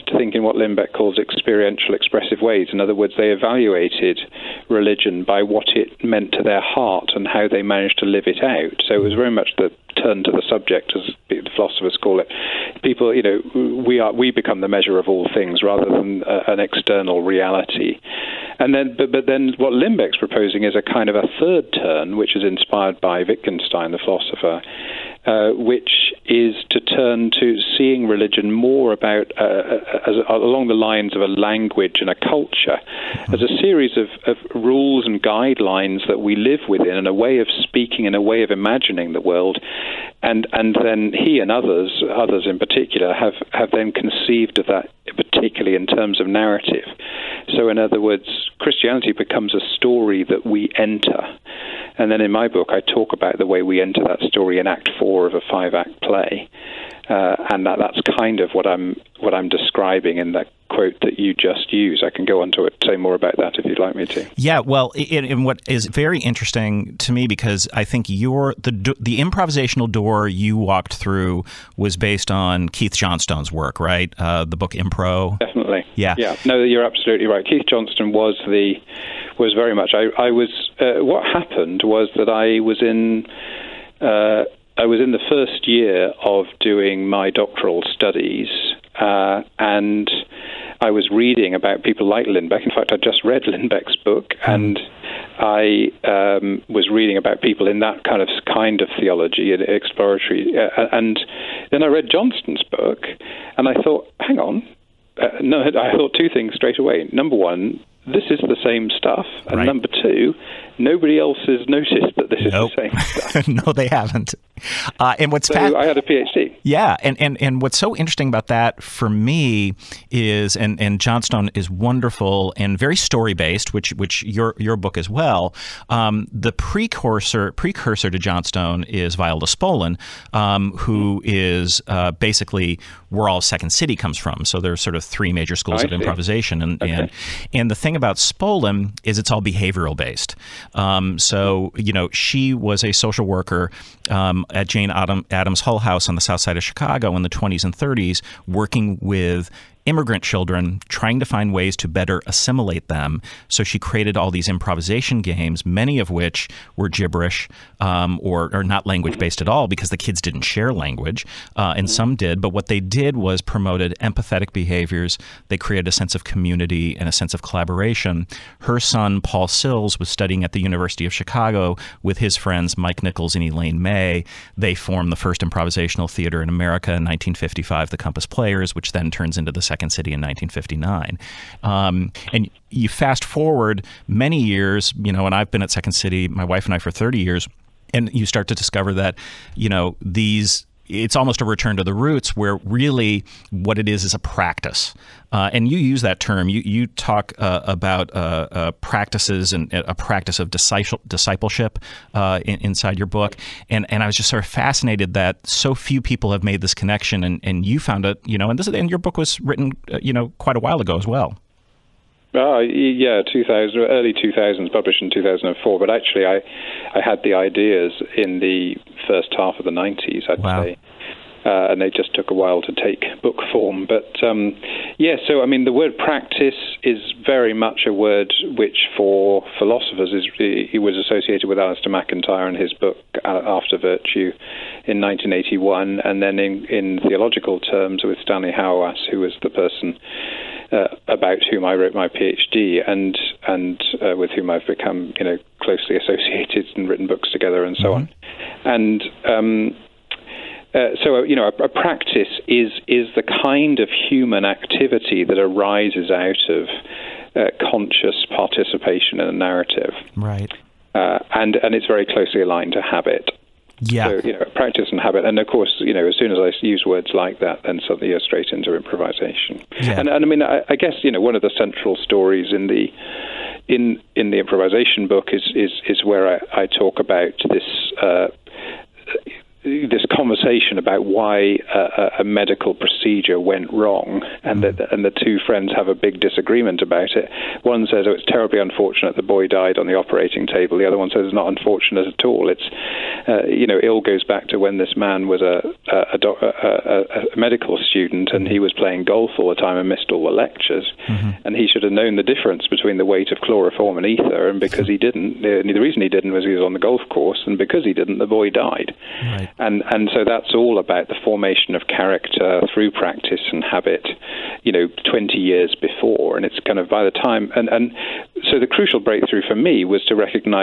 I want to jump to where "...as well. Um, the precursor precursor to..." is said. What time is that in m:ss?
2:04.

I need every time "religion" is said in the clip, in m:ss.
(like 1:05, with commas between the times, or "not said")
0:04, 0:28.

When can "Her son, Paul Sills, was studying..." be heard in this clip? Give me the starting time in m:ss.
2:48.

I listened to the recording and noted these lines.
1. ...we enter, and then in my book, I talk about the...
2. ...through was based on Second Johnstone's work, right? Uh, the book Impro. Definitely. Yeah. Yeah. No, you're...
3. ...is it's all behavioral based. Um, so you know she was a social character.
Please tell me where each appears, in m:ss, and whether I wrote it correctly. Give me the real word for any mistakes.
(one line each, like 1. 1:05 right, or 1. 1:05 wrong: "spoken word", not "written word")
1. 0:50 right
2. 1:10 wrong: "Keith", not "Second"
3. 2:19 wrong: "worker", not "character".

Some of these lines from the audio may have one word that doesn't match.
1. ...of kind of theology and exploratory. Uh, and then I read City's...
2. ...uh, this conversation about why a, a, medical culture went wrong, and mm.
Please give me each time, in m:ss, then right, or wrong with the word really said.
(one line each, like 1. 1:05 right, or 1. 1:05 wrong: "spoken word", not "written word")
1. 1:38 wrong: "Johnstone", not "City"
2. 4:38 wrong: "procedure", not "culture".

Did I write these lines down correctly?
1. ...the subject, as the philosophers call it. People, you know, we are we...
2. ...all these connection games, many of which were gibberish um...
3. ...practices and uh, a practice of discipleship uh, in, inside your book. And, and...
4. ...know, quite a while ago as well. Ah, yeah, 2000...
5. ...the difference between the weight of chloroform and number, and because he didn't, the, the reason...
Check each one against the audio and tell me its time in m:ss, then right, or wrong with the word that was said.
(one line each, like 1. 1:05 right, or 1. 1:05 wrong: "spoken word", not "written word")
1. 0:10 right
2. 2:34 wrong: "improvisation", not "connection"
3. 3:18 right
4. 3:30 right
5. 5:02 wrong: "ether", not "number".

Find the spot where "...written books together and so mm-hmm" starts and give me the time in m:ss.
4:06.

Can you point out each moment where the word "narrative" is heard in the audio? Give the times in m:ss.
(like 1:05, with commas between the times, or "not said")
0:46, 4:19.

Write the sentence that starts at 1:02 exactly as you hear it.
I can go on to it, say more about that if you'd like me to.